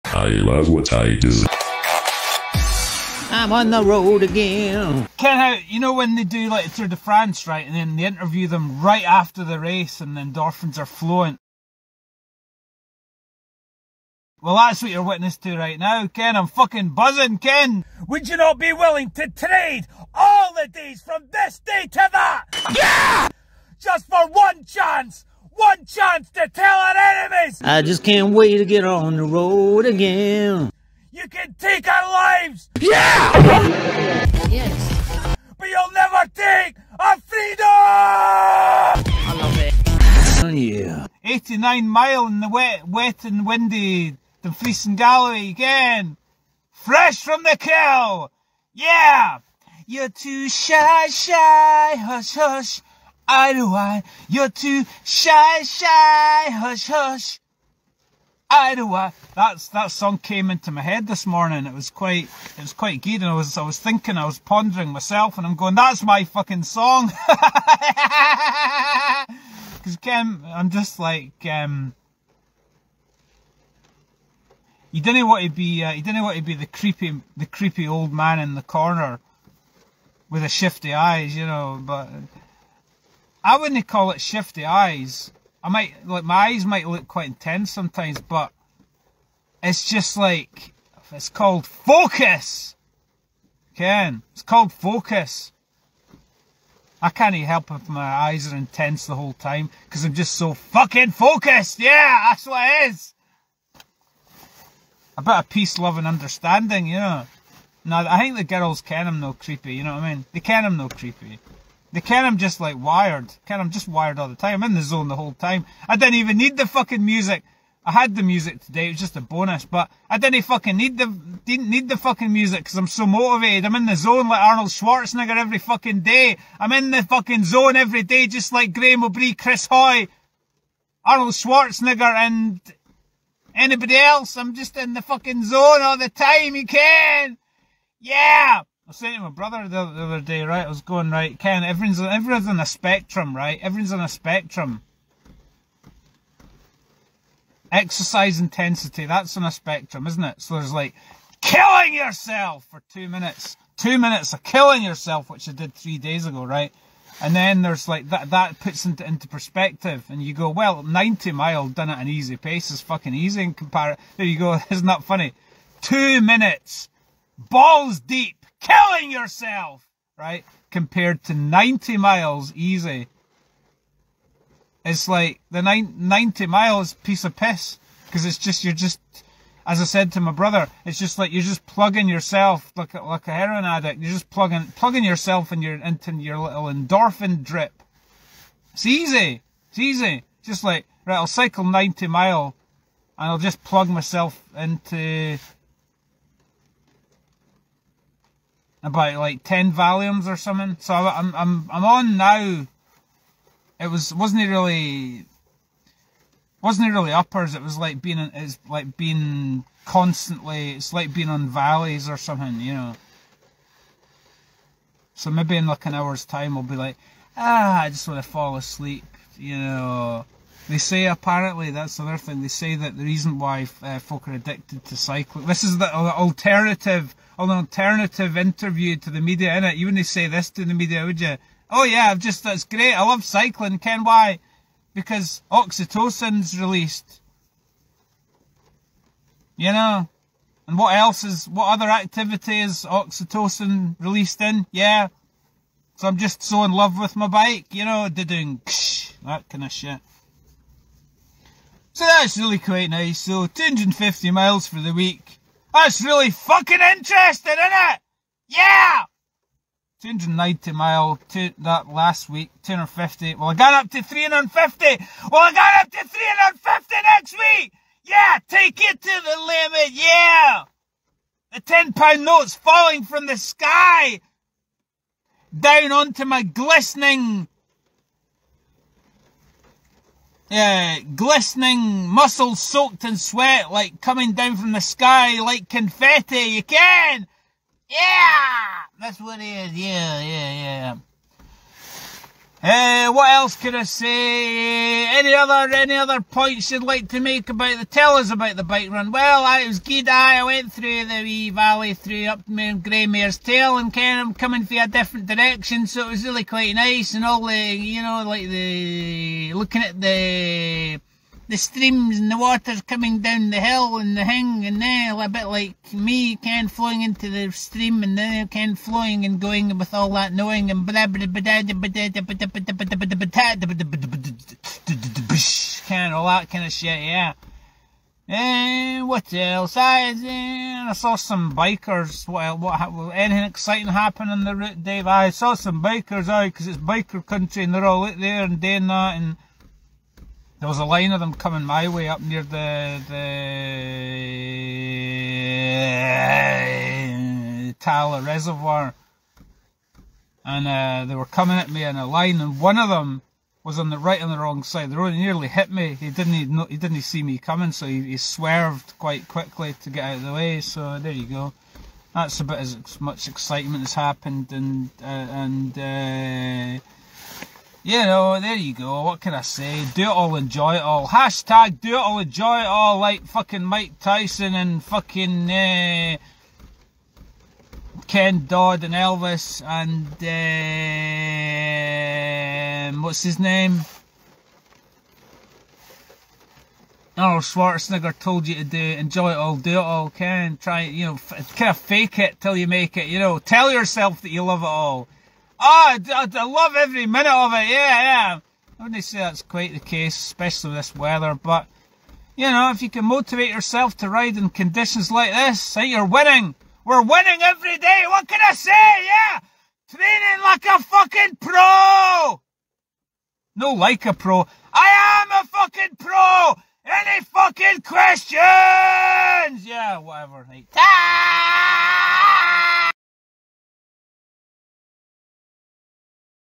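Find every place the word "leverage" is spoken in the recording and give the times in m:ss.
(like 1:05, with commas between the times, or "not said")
not said.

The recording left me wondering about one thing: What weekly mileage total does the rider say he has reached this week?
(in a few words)
250 miles.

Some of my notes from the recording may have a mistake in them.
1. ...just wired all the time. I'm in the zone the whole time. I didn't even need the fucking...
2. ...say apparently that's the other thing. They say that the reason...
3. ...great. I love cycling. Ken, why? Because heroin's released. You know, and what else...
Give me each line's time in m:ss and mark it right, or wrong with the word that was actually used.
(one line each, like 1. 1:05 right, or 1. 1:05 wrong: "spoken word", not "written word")
1. 1:53 right
2. 3:40 right
3. 3:52 wrong: "oxytocin", not "heroin".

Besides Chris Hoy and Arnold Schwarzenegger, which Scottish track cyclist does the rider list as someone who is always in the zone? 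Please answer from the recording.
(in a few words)
Graeme Obree.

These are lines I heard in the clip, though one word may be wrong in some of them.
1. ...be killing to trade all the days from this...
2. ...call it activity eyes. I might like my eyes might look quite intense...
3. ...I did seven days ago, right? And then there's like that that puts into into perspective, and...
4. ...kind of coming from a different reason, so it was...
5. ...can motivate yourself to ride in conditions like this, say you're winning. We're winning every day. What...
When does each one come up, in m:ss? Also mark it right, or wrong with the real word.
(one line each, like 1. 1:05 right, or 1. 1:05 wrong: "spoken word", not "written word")
1. 0:18 wrong: "willing", not "killing"
2. 1:23 wrong: "shifty", not "activity"
3. 2:35 wrong: "three", not "seven"
4. 5:03 wrong: "direction", not "reason"
5. 6:42 right.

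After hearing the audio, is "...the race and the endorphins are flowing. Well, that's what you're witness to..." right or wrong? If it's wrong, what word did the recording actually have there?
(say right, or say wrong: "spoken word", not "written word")
right.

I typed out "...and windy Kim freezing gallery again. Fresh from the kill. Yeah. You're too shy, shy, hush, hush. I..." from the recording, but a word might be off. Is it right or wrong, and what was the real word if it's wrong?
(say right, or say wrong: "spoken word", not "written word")
wrong: "The", not "Kim".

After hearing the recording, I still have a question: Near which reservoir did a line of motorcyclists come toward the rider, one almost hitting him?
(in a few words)
Talla Reservoir.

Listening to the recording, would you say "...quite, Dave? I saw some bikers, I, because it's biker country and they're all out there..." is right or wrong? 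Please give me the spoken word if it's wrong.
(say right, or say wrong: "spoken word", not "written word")
wrong: "route", not "quite".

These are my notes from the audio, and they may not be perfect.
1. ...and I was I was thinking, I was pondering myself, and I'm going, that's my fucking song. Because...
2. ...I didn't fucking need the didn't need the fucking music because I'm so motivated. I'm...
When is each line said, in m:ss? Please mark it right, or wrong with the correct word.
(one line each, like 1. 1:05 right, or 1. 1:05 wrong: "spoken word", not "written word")
1. 1:03 right
2. 2:00 right.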